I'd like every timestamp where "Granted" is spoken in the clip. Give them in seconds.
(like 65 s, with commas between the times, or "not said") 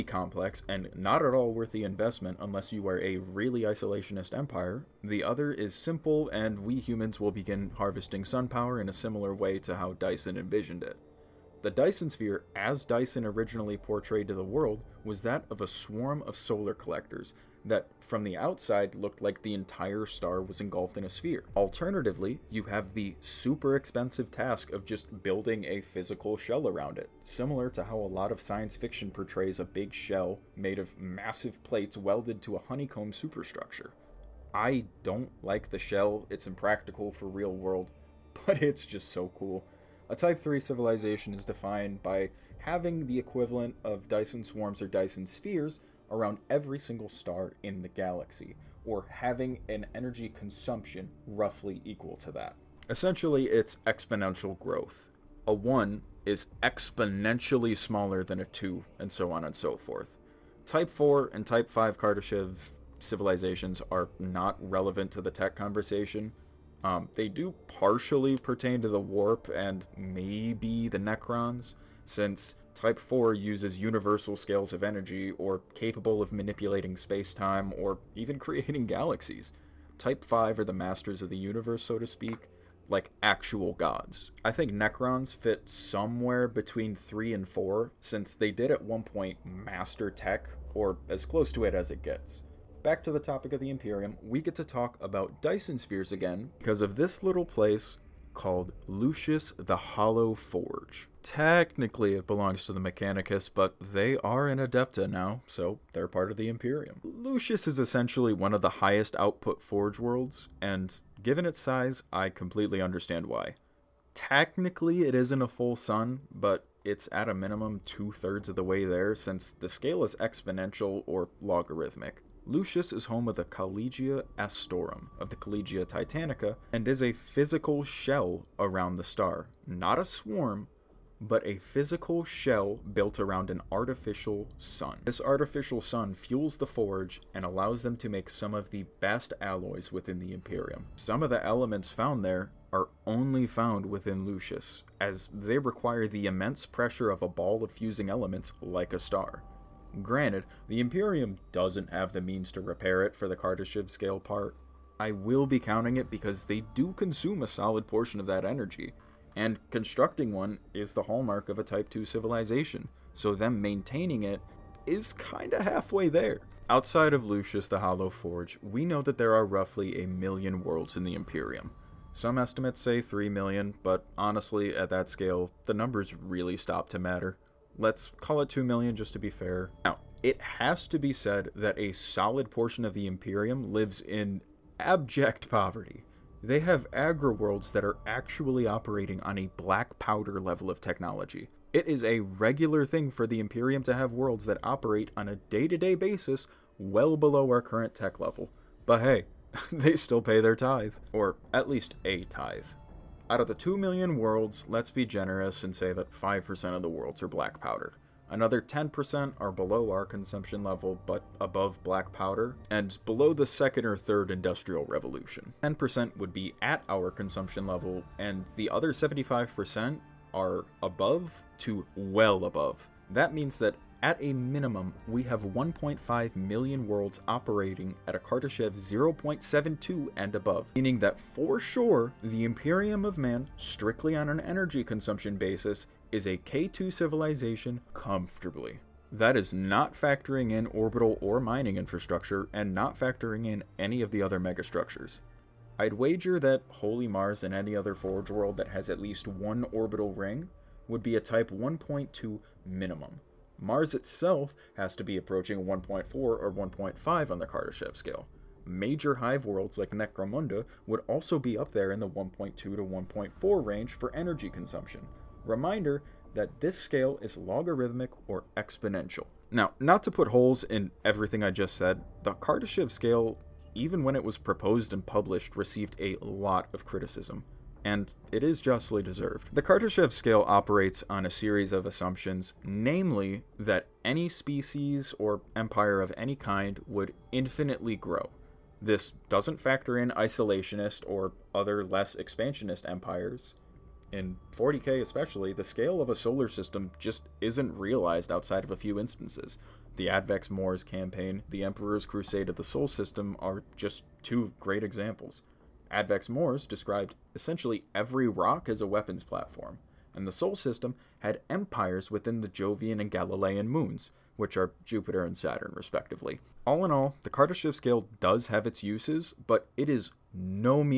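150 s.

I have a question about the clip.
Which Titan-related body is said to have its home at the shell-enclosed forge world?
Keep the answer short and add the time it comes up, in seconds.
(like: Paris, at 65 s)
Collegia Astorum, at 123 s.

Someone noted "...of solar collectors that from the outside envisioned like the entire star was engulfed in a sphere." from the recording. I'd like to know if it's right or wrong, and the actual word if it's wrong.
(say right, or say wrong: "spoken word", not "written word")
wrong: "looked", not "envisioned".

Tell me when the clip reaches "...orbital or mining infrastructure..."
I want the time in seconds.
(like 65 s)
240 s.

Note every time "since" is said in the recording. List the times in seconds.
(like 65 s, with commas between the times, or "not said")
72 s, 88 s, 119 s.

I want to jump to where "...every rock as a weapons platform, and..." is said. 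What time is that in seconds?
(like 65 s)
307 s.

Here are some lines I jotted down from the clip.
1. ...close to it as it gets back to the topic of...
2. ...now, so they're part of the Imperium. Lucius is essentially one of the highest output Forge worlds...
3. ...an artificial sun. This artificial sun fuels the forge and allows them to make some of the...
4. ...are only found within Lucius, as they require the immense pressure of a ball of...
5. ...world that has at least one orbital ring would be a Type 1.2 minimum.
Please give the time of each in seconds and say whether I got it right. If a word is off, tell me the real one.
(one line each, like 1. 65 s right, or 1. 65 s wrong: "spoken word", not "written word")
1. 91 s right
2. 105 s right
3. 133 s right
4. 142 s right
5. 248 s right.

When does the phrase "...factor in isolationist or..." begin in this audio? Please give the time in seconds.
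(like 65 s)
289 s.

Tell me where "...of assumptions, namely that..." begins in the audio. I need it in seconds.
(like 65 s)
281 s.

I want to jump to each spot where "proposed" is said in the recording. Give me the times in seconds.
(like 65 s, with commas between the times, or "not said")
274 s.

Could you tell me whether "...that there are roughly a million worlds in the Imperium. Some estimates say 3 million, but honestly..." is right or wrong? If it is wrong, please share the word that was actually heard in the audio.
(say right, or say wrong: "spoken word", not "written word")
right.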